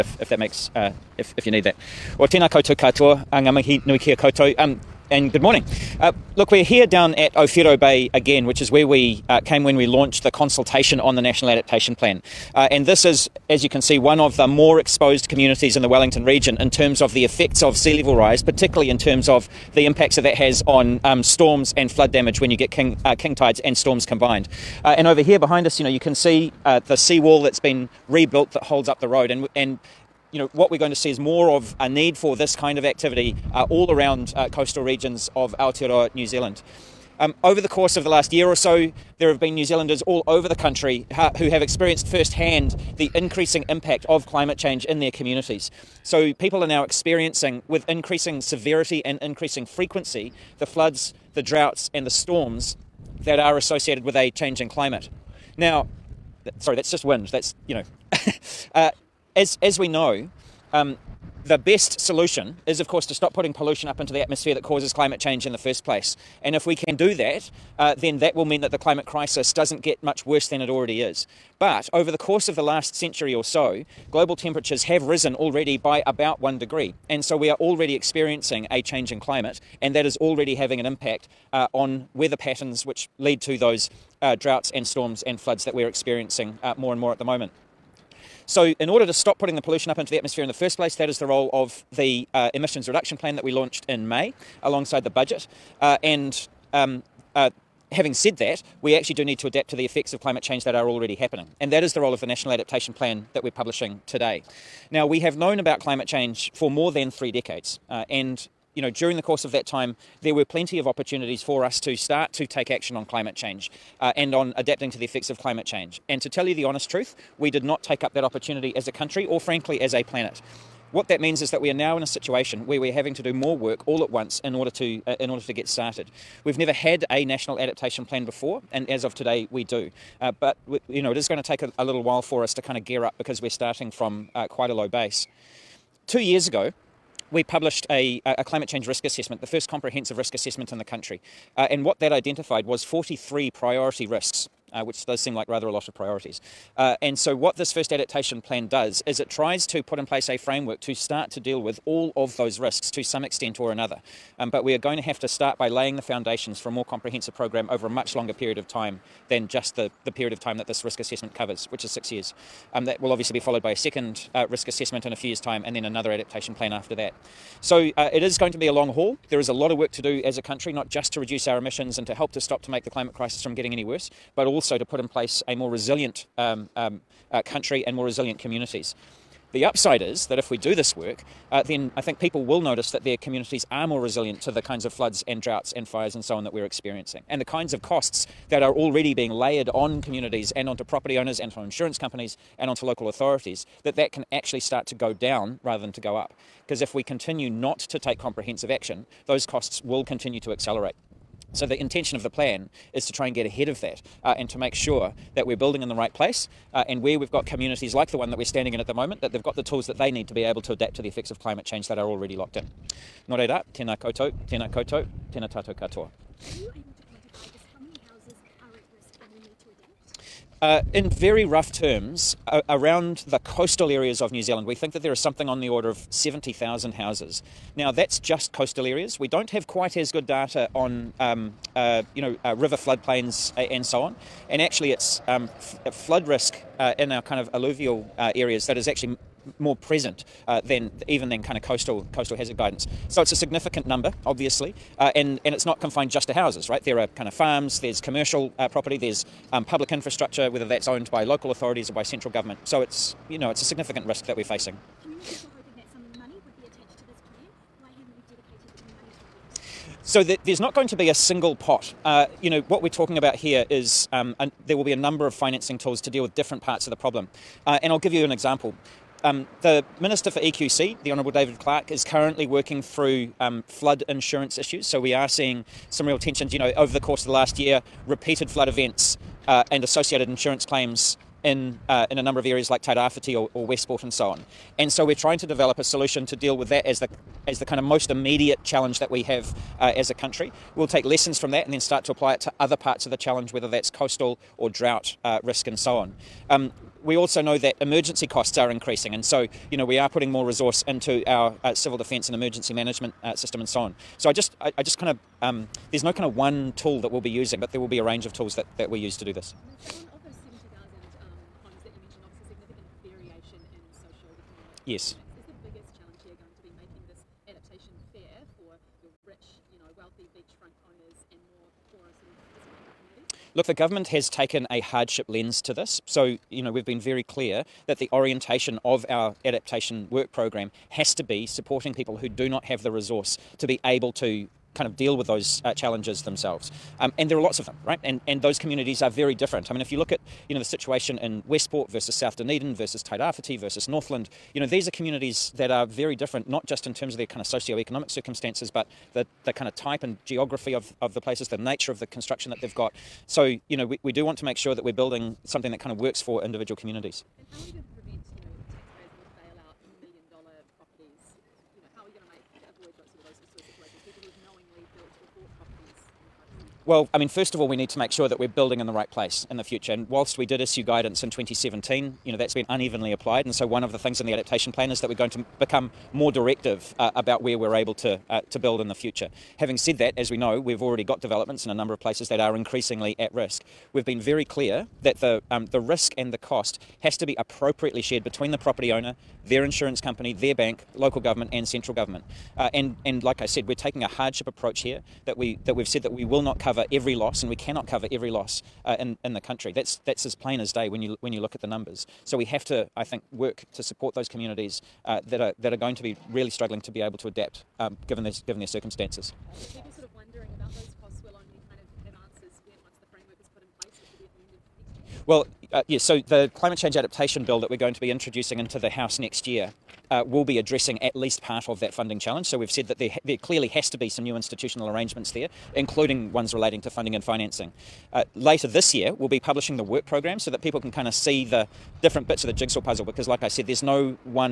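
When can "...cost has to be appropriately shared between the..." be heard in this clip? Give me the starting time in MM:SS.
06:26.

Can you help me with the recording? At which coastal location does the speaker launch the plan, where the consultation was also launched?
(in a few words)
Owhiro Bay.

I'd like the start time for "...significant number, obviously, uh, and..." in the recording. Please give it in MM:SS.
04:03.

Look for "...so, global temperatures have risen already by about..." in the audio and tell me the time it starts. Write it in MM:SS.
01:13.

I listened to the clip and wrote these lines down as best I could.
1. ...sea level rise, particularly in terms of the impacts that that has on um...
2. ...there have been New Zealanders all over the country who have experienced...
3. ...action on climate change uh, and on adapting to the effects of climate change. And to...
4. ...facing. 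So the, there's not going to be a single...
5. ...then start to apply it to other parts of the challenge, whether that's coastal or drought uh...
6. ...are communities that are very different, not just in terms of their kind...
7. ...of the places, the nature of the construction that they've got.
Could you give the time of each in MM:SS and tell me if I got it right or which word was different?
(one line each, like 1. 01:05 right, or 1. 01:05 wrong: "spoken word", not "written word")
1. 00:17 right
2. 00:39 right
3. 01:52 right
4. 04:14 right
5. 04:51 right
6. 05:44 right
7. 05:51 right.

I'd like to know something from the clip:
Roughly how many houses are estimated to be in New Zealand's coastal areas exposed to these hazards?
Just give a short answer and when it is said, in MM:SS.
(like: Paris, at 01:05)
70,000, at 03:46.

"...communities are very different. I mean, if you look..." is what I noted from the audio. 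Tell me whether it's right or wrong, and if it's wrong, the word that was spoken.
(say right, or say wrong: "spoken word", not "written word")
right.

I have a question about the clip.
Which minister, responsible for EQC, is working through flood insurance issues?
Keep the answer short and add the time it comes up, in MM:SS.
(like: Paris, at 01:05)
David Clark, at 04:31.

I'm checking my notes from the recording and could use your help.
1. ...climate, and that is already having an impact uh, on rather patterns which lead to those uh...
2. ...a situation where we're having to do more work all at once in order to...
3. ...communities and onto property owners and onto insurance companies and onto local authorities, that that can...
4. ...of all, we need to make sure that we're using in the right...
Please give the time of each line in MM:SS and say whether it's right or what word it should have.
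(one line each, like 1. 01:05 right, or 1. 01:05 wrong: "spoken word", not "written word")
1. 01:19 wrong: "weather", not "rather"
2. 02:02 right
3. 03:09 right
4. 06:07 wrong: "building", not "using".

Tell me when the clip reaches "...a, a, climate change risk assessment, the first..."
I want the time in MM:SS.
02:17.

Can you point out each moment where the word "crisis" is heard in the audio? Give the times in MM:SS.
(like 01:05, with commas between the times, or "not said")
01:09, 02:53.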